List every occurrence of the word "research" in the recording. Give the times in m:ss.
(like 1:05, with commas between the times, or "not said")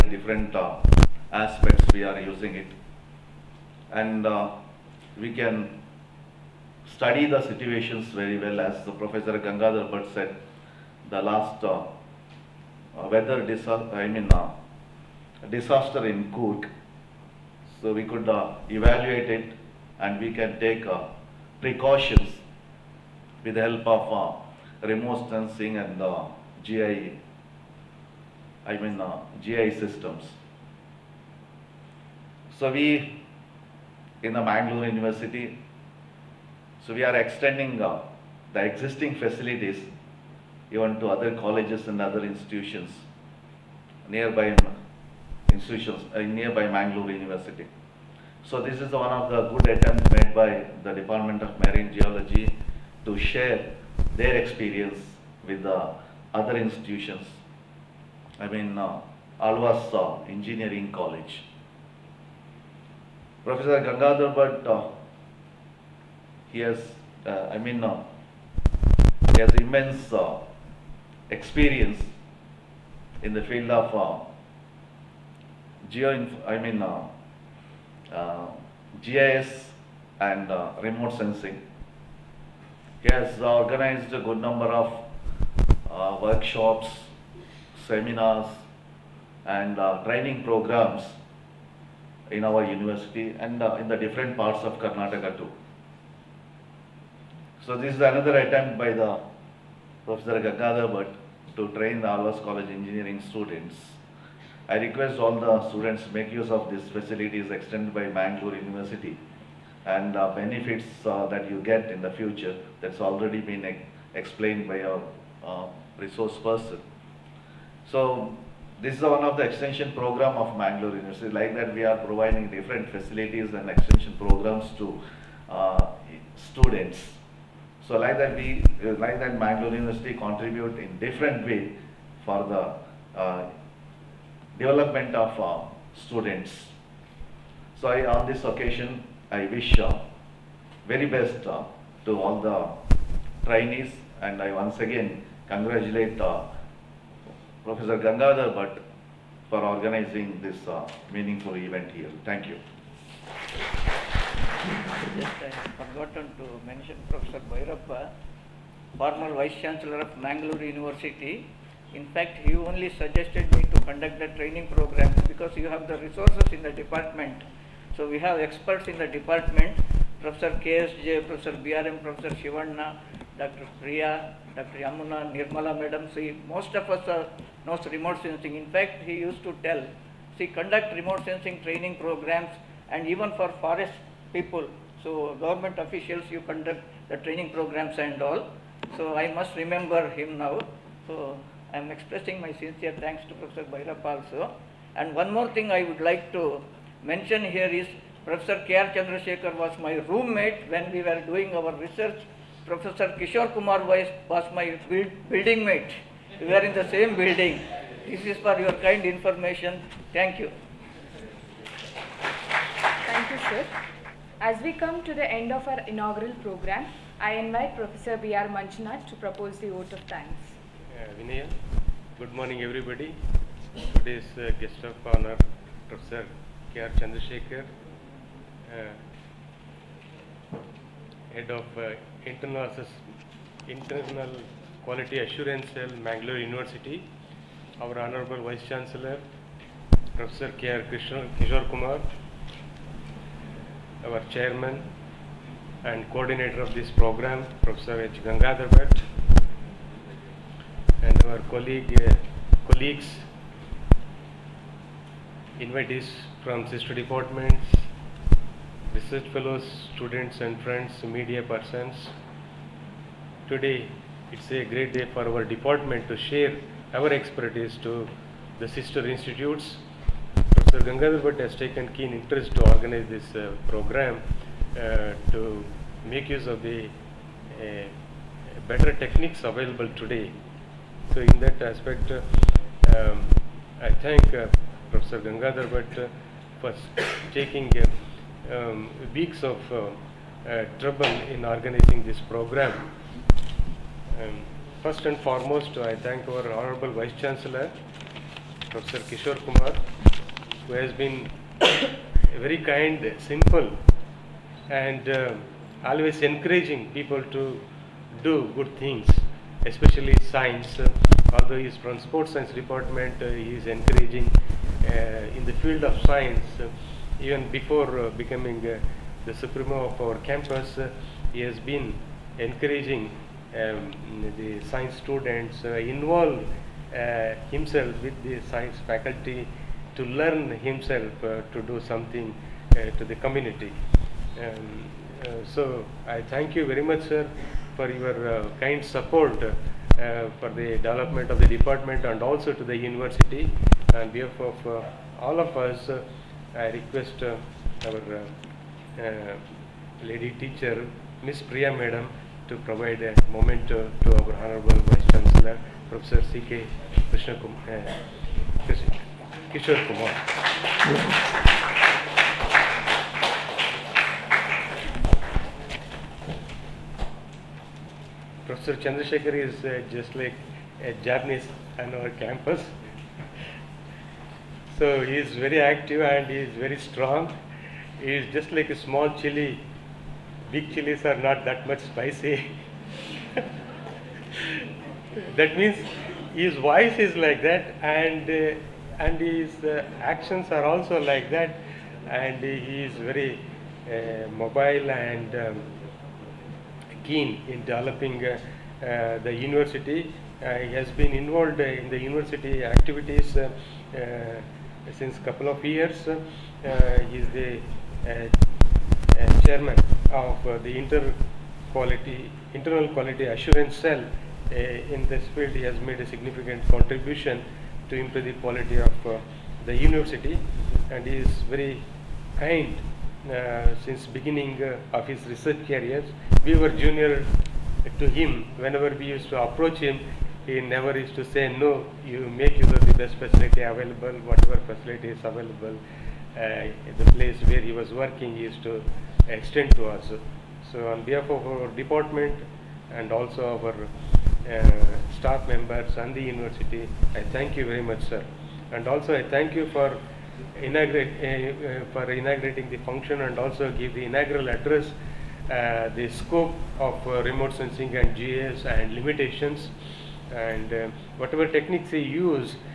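3:21, 4:18, 7:05.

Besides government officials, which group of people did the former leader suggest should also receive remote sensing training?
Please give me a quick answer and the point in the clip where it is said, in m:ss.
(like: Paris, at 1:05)
forest people, at 3:03.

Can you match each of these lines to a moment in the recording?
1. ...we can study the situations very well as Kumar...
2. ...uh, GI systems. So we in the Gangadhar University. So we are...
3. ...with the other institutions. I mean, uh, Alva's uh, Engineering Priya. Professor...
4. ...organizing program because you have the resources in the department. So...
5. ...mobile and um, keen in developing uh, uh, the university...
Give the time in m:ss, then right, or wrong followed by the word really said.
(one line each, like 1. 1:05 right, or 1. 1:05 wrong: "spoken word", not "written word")
1. 0:05 wrong: "Professor", not "Kumar"
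2. 0:29 wrong: "Mangalore", not "Gangadhar"
3. 0:55 wrong: "College", not "Priya"
4. 2:44 wrong: "training", not "organizing"
5. 6:34 right.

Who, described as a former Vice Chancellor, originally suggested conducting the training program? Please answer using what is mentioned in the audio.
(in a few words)
Professor Bhairappa.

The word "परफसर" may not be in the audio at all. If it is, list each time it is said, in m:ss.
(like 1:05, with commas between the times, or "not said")
4:00, 4:07.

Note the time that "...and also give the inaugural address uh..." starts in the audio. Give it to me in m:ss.
7:33.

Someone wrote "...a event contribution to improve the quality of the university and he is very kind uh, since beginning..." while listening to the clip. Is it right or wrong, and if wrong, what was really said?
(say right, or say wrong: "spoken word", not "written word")
wrong: "significant", not "event".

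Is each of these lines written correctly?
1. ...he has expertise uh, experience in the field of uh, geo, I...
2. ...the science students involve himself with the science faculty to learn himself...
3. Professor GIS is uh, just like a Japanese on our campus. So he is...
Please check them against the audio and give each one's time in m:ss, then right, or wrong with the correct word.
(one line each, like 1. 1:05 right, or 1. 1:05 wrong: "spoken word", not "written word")
1. 1:09 wrong: "immense", not "expertise"
2. 5:24 right
3. 6:08 wrong: "Chandrasekhar", not "GIS".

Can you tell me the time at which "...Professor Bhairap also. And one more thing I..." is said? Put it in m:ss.
3:13.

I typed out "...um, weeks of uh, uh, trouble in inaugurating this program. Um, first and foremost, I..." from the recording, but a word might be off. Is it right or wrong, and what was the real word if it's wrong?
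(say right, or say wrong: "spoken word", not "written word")
wrong: "organizing", not "inaugurating".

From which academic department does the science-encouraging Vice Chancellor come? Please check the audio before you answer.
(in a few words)
sports science.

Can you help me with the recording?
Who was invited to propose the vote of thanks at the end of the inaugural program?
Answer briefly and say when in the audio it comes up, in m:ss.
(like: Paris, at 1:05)
B.R. Manjunath, at 3:37.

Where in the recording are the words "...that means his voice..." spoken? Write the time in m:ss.
6:25.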